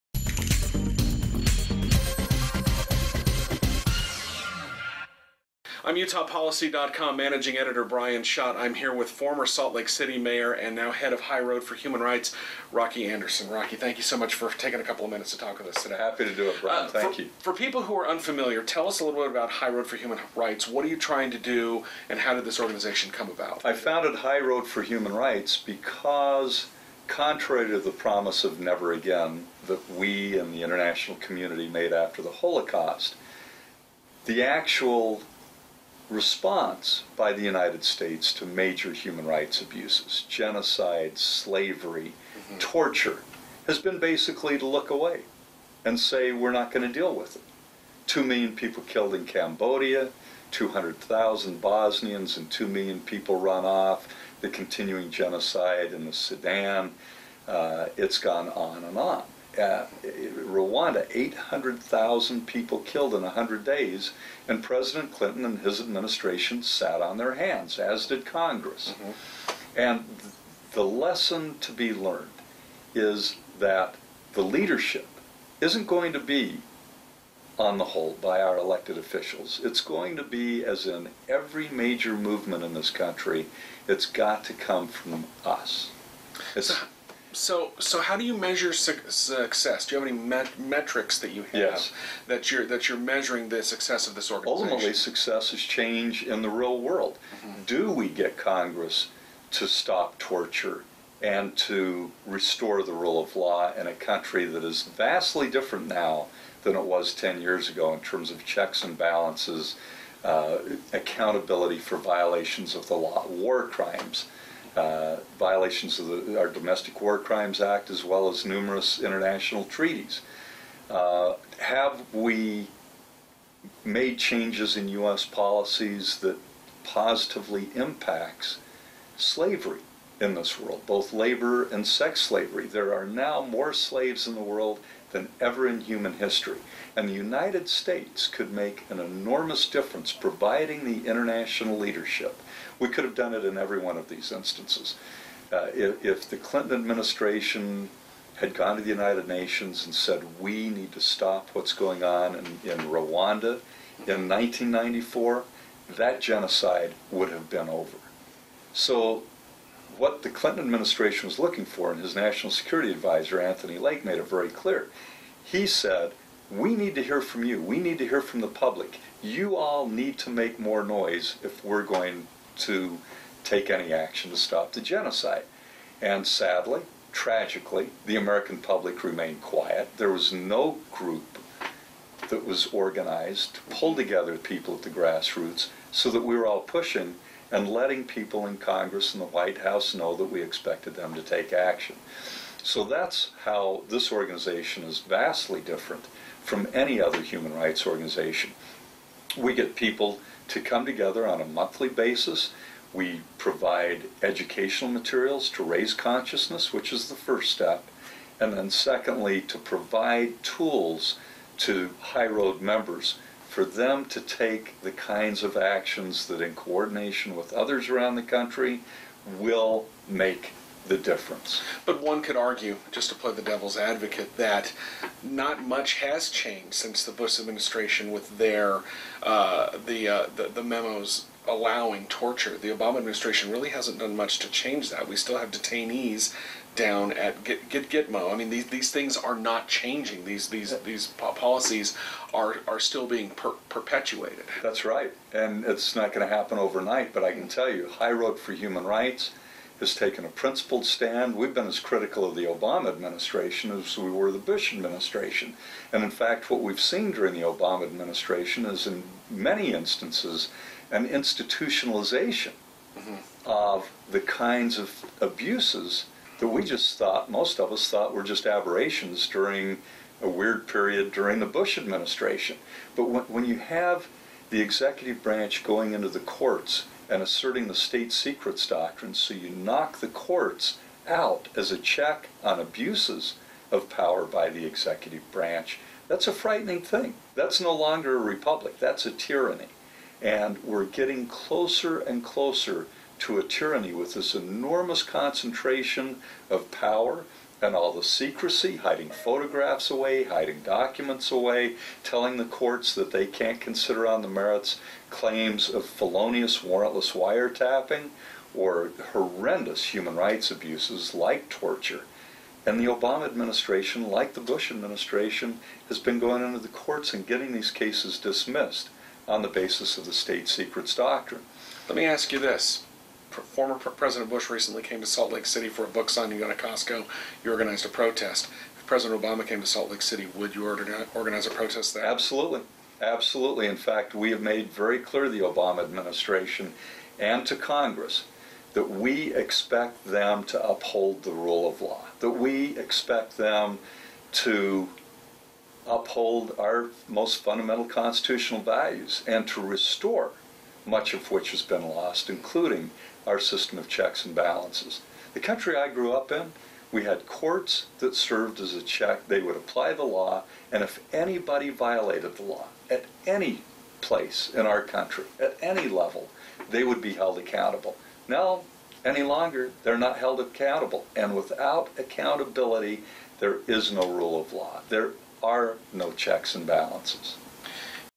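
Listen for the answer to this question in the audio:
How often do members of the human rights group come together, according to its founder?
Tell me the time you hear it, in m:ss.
3:21.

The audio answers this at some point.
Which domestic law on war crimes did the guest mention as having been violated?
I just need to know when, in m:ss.
1:56.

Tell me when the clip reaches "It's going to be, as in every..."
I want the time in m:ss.
1:19.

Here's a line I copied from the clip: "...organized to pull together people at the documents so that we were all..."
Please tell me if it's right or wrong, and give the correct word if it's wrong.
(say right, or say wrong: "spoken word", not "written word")
wrong: "grassroots", not "documents".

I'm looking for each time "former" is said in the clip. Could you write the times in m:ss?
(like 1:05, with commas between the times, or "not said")
0:09, 5:23.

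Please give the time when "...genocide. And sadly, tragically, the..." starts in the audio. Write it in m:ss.
2:54.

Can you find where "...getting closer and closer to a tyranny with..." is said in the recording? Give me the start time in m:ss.
4:50.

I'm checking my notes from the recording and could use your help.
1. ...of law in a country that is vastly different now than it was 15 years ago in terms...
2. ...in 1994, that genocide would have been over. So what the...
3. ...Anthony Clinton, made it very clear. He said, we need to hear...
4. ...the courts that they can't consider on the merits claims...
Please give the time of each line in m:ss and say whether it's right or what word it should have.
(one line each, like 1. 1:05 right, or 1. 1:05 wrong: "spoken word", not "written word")
1. 1:43 wrong: "10", not "15"
2. 2:34 right
3. 2:43 wrong: "Lake", not "Clinton"
4. 5:02 right.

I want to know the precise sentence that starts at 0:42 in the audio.
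torture, has been basically to look away and say, we're not going to deal with it.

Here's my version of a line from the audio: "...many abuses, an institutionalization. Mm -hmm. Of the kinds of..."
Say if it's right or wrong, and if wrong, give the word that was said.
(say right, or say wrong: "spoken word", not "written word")
wrong: "instances", not "abuses".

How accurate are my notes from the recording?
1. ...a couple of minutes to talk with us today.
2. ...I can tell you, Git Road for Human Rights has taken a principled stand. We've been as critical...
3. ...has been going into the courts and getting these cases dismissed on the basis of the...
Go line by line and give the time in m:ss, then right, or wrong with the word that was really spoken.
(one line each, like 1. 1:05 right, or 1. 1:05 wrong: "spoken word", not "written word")
1. 0:14 right
2. 4:07 wrong: "High", not "Git"
3. 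5:15 right.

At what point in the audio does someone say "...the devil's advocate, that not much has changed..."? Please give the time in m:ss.
3:43.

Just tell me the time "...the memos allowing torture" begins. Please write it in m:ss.
3:50.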